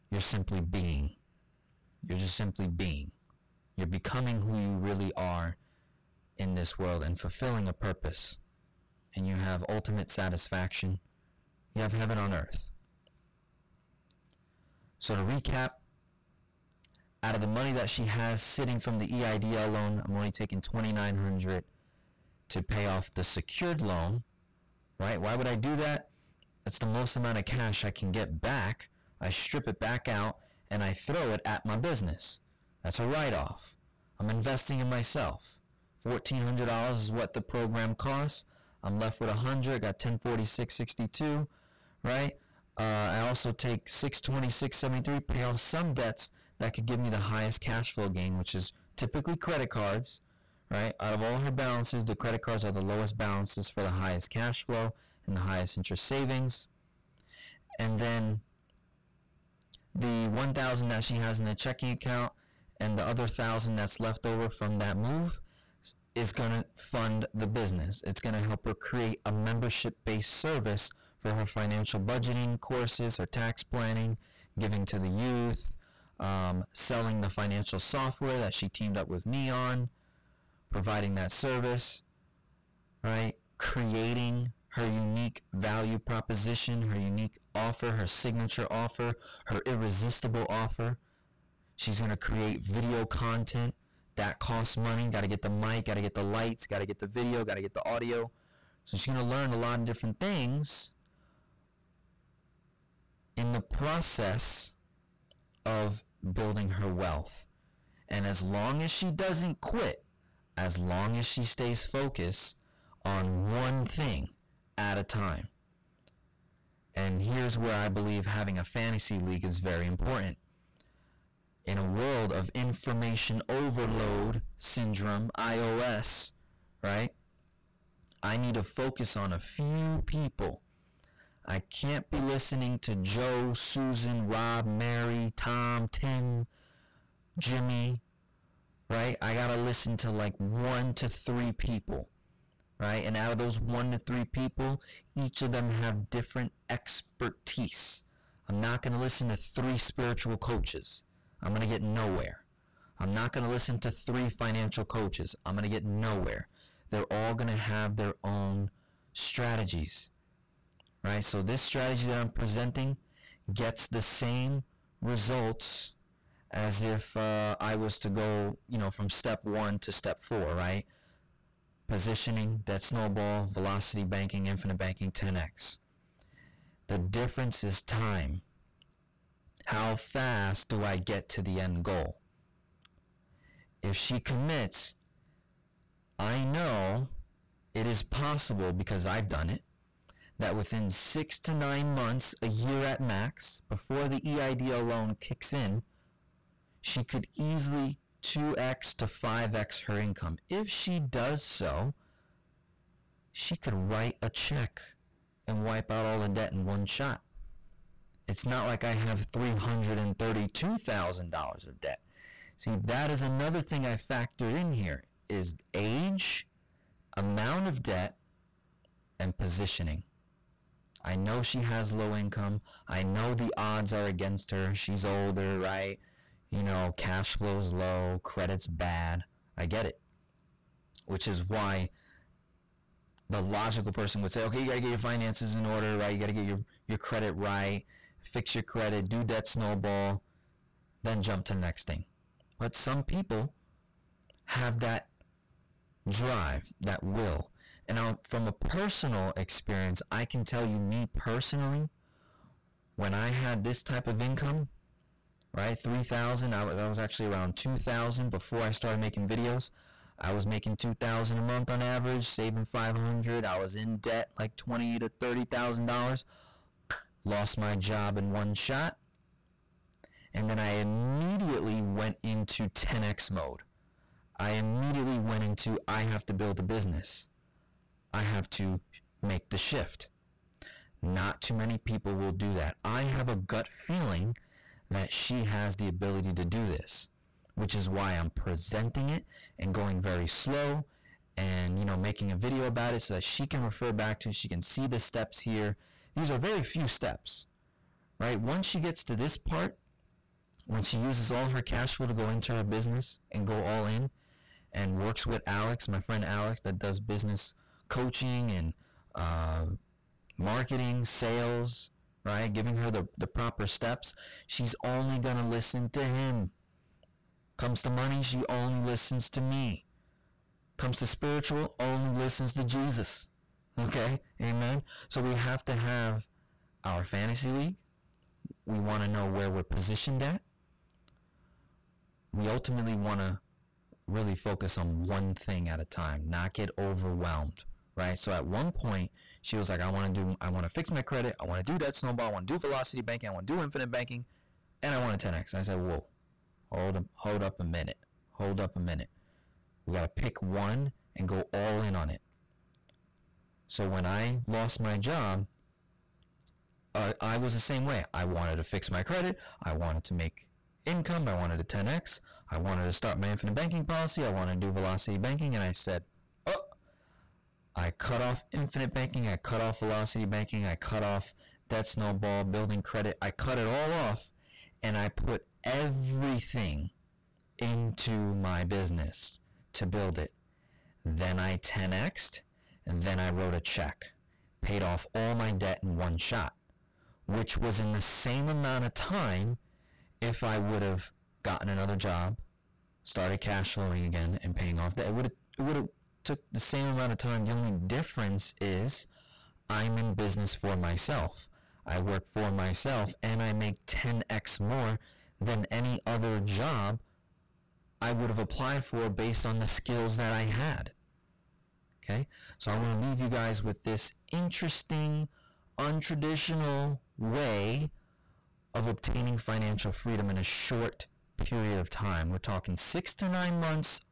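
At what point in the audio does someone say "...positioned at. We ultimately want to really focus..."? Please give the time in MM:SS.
05:29.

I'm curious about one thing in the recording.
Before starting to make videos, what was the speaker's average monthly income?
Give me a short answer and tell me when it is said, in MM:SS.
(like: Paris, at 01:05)
$2,000, at 04:20.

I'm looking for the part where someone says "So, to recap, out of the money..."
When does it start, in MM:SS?
00:14.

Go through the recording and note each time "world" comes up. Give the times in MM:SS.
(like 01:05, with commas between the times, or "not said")
00:06, 02:01.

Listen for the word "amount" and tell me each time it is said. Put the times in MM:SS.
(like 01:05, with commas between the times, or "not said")
00:27, 03:37, 06:28, 06:36.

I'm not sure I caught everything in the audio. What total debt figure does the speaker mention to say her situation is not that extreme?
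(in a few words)
$332,000.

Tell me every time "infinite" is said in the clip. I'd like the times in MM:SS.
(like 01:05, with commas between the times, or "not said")
02:54, 05:43, 06:03, 06:08.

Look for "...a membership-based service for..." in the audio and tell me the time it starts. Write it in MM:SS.
01:09.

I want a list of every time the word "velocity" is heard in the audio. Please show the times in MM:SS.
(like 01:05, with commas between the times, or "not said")
02:53, 05:42, 06:04, 06:09.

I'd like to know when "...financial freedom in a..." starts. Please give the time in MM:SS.
06:59.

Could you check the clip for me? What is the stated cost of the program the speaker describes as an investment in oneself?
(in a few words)
$1,400.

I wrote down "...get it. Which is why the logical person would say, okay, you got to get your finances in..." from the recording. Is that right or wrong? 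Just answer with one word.
right.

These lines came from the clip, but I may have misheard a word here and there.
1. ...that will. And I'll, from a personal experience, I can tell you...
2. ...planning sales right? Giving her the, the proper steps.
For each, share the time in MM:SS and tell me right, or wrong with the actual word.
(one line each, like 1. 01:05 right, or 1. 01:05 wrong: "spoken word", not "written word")
1. 04:06 right
2. 05:10 wrong: "marketing", not "planning".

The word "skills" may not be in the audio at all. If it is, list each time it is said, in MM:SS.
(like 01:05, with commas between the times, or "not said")
06:49.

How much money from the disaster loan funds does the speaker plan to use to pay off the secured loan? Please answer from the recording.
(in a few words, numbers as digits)
$2,900.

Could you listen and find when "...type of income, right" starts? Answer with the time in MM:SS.
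04:13.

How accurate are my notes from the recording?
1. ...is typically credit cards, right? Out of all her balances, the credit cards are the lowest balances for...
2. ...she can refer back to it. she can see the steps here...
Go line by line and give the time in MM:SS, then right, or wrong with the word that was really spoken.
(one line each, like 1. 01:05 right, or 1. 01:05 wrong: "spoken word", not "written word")
1. 00:48 right
2. 04:53 right.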